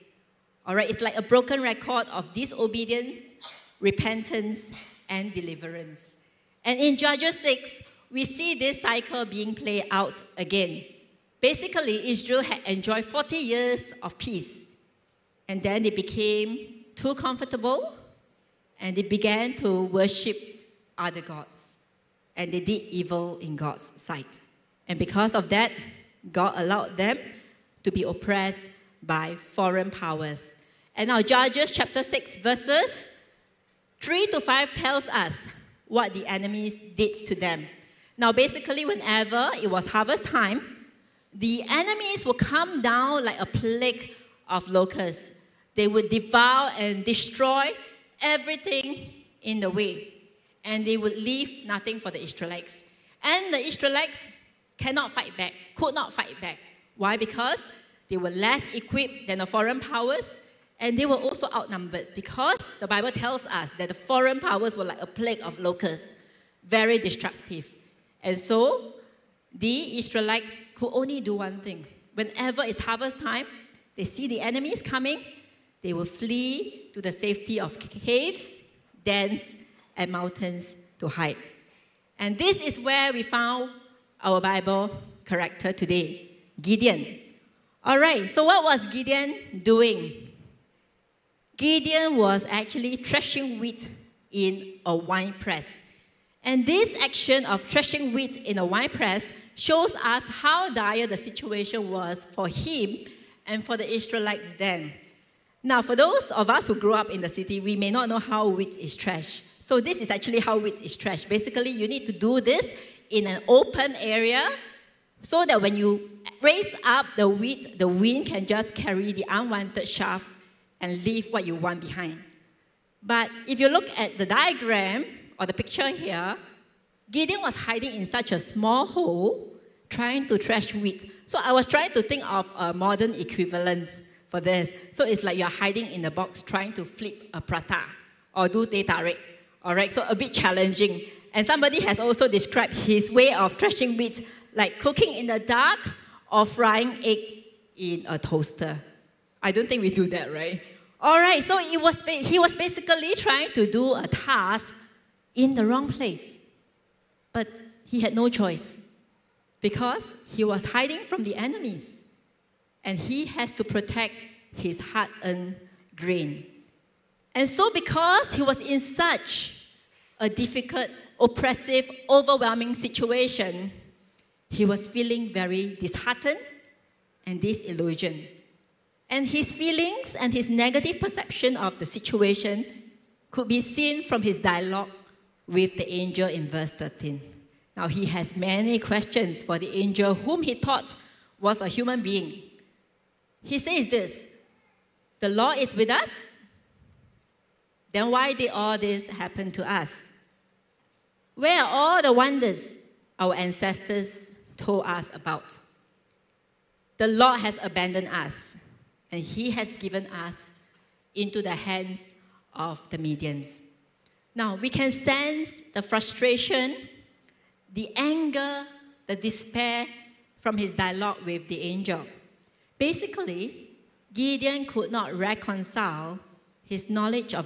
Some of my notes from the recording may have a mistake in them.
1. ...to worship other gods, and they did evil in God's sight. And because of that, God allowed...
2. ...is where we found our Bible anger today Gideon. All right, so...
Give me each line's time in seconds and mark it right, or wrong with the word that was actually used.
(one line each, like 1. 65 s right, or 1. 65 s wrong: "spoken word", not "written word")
1. 19 s right
2. 82 s wrong: "character", not "anger".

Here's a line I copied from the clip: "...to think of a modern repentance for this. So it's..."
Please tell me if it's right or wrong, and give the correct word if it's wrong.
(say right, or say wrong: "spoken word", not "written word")
wrong: "equivalence", not "repentance".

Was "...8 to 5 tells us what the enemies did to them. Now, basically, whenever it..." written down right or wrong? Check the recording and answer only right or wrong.
wrong.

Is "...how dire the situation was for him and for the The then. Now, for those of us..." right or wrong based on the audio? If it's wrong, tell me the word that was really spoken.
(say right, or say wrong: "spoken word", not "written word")
wrong: "Israelites", not "The".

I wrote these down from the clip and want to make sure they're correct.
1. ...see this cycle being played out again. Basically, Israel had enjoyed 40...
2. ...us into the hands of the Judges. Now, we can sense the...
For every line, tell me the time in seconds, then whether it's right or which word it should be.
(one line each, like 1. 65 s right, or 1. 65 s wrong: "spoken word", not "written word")
1. 8 s right
2. 210 s wrong: "Midians", not "Judges".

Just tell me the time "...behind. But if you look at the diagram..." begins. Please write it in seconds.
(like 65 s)
121 s.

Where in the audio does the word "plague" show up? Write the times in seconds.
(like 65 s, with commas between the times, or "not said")
43 s, 65 s.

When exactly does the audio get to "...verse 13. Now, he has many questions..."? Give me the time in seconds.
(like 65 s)
186 s.